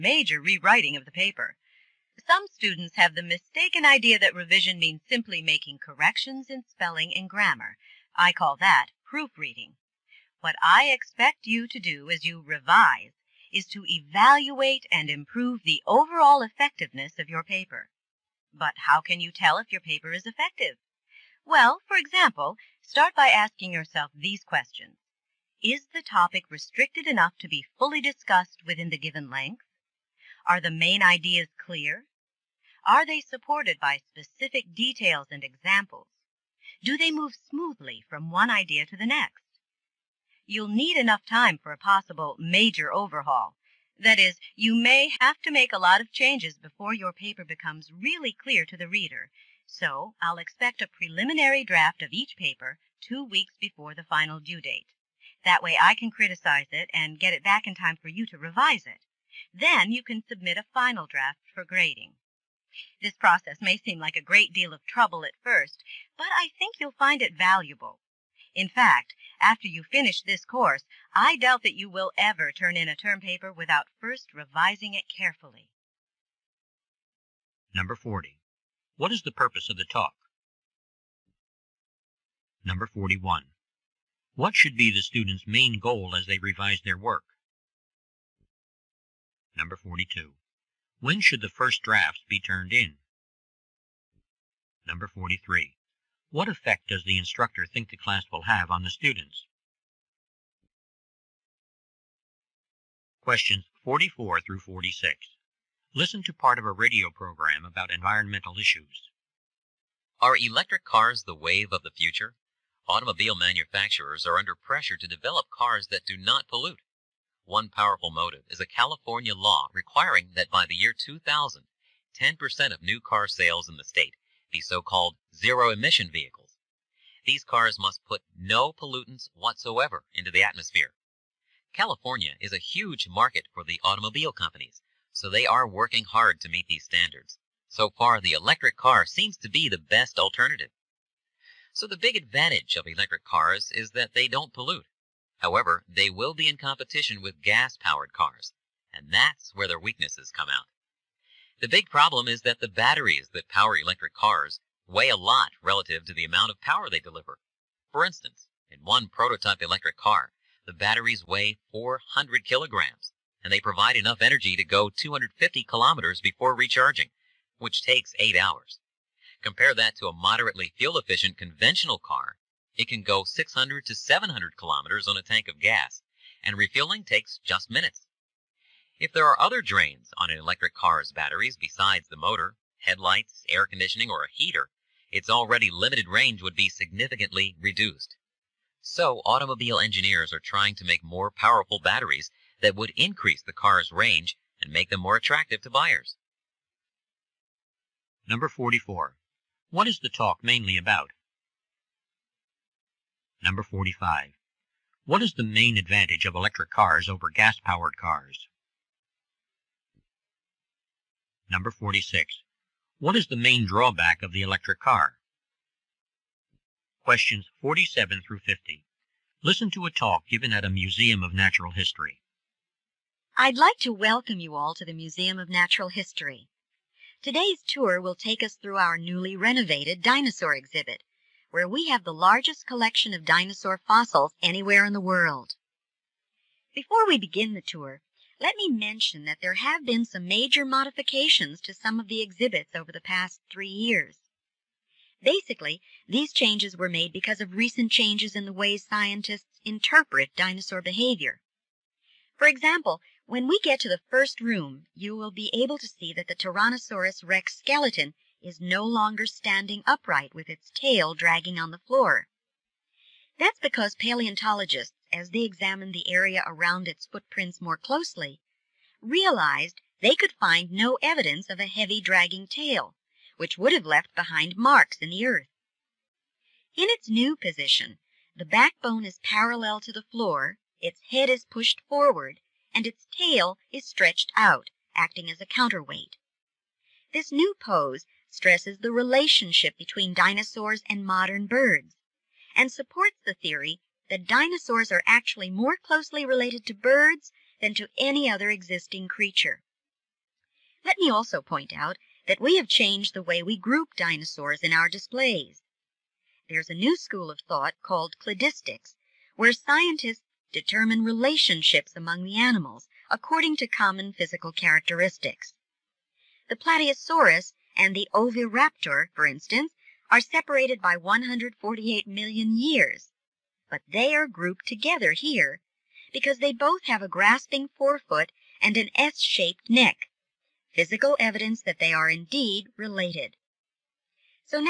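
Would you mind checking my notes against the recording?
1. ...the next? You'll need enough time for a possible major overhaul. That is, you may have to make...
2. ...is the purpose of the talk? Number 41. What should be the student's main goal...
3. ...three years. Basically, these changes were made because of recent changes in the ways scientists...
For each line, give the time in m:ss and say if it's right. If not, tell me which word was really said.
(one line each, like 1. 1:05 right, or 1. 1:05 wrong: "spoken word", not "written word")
1. 0:38 right
2. 1:19 right
3. 4:03 right.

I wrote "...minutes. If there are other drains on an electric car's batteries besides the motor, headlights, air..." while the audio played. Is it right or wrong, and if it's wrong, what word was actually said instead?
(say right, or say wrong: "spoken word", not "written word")
right.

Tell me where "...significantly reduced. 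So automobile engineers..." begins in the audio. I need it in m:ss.
3:06.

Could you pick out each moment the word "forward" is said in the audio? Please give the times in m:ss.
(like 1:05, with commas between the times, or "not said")
4:41.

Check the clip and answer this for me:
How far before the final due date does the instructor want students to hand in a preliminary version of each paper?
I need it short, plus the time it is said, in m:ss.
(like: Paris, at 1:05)
2 weeks, at 0:53.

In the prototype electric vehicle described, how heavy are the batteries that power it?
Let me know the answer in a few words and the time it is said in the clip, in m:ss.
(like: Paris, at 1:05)
400 kilograms, at 2:41.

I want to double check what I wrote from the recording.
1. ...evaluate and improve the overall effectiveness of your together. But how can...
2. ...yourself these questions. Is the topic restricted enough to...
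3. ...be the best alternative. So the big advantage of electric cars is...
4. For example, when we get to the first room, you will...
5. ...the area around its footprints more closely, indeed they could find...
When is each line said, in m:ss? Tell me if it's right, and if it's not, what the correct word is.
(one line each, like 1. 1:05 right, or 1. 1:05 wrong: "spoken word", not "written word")
1. 0:13 wrong: "paper", not "together"
2. 0:23 right
3. 2:19 right
4. 4:12 right
5. 4:25 wrong: "realized", not "indeed".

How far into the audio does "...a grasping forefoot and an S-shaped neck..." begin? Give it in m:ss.
5:27.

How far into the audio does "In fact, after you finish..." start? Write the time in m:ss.
1:08.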